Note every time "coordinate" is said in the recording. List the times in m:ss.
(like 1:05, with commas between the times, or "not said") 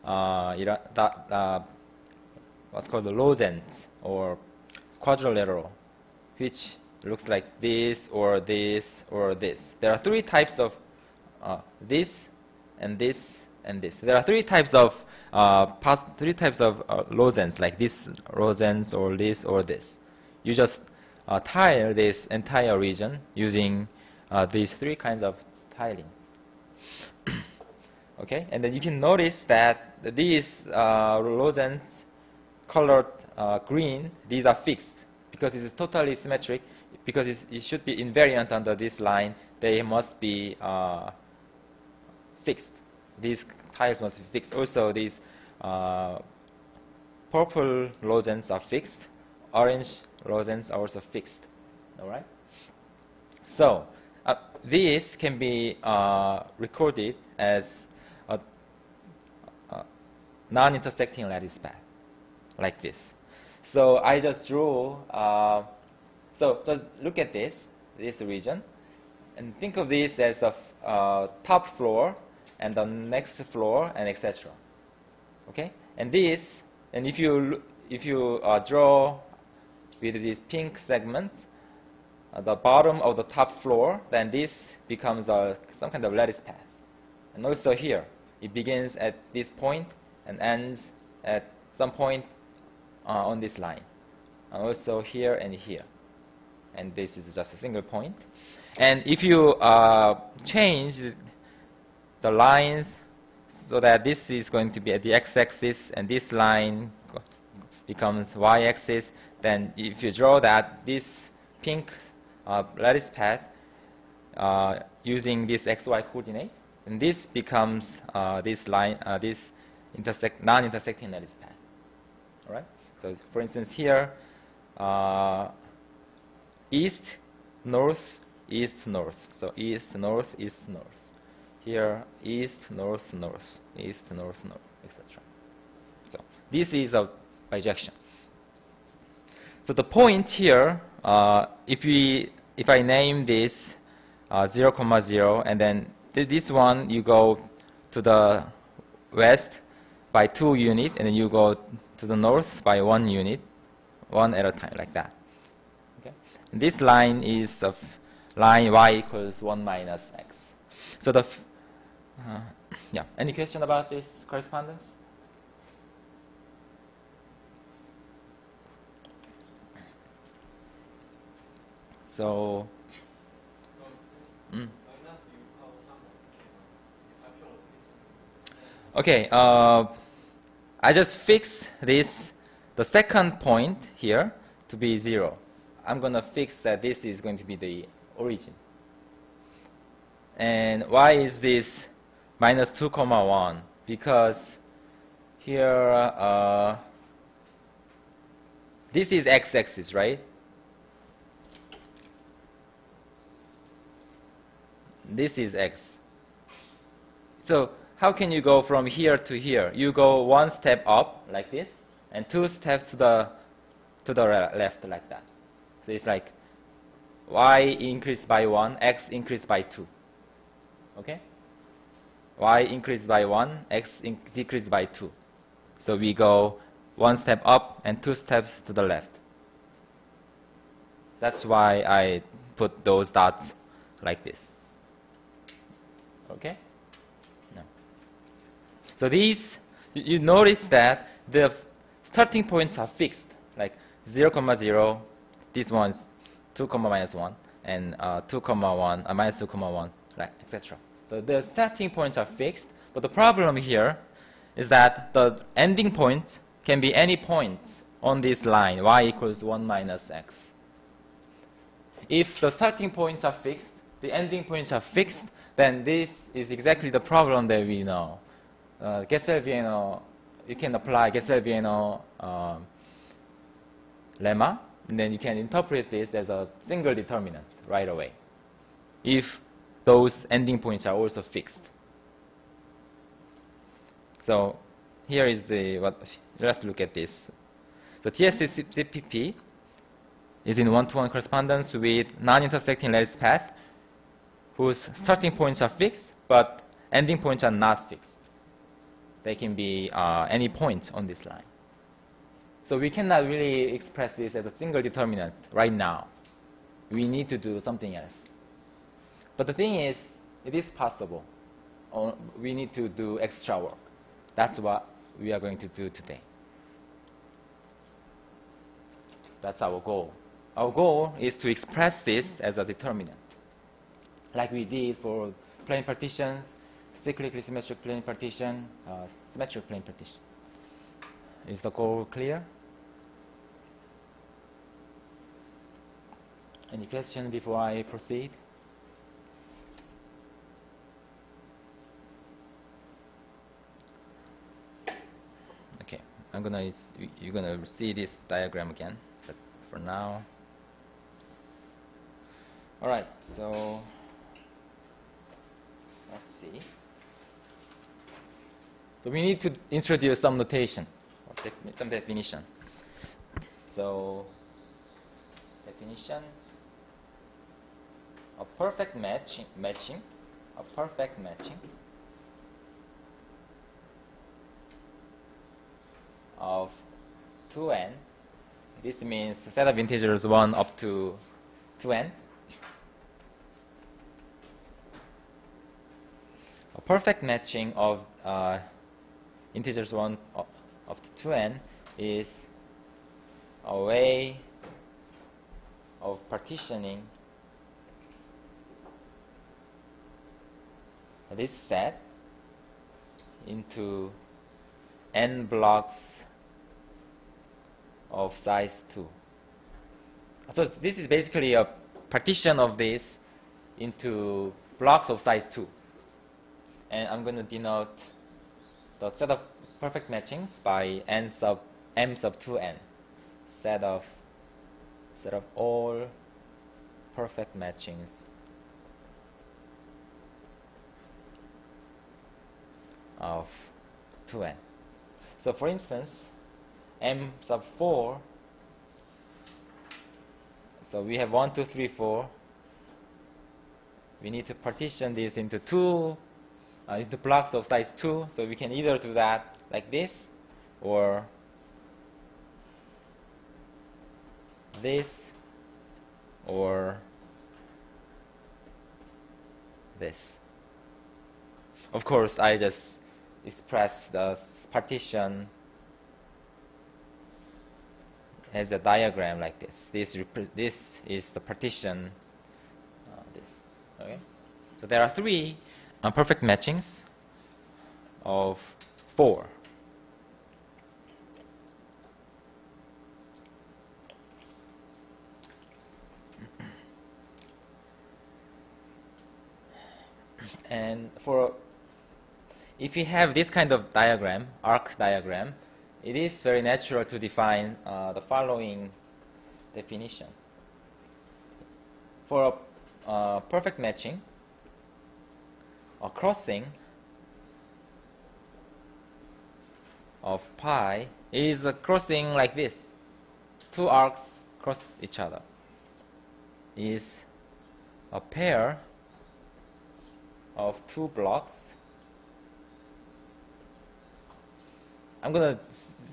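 1:56.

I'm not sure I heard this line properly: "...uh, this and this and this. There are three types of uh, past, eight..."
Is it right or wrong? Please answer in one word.
wrong.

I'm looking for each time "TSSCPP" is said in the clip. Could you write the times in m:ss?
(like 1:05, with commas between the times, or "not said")
4:48.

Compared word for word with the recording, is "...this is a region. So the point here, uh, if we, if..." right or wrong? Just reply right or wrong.
wrong.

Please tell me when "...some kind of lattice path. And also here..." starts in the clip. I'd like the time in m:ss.
1:25.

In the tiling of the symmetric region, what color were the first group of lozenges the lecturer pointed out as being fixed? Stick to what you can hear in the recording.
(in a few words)
Green.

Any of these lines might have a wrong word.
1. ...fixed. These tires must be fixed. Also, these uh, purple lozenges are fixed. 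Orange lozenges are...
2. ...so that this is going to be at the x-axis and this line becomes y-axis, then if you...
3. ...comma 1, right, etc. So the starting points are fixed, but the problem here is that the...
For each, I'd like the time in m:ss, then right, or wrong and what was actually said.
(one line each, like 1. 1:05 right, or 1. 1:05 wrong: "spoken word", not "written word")
1. 0:42 right
2. 1:43 right
3. 4:09 right.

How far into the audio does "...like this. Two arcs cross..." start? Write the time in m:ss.
8:32.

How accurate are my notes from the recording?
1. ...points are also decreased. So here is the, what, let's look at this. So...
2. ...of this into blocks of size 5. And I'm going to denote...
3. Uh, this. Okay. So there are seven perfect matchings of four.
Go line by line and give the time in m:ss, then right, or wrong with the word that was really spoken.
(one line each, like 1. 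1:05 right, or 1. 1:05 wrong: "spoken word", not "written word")
1. 4:40 wrong: "fixed", not "decreased"
2. 6:52 wrong: "2", not "5"
3. 7:53 wrong: "three", not "seven".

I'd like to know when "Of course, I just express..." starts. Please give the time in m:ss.
7:41.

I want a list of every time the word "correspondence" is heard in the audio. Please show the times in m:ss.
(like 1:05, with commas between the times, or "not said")
2:44, 4:51.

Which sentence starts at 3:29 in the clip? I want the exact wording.
You go one step up like this, and two steps to the, to the left like that.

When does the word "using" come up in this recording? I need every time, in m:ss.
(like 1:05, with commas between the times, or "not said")
0:23, 1:55.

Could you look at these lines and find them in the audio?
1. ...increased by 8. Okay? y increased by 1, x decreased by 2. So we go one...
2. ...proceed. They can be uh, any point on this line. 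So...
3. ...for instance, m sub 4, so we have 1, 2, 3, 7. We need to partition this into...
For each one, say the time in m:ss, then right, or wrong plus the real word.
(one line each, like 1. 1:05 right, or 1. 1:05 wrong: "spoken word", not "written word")
1. 3:39 wrong: "2", not "8"
2. 4:57 wrong: "fixed", not "proceed"
3. 7:15 wrong: "4", not "7".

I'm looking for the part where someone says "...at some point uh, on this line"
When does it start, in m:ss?
1:31.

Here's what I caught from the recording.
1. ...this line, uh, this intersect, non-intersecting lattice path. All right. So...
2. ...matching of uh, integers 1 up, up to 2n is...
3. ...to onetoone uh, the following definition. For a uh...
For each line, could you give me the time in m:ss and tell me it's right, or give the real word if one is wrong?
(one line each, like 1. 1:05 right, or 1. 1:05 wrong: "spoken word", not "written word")
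1. 1:58 right
2. 6:27 right
3. 8:17 wrong: "define", not "onetoone".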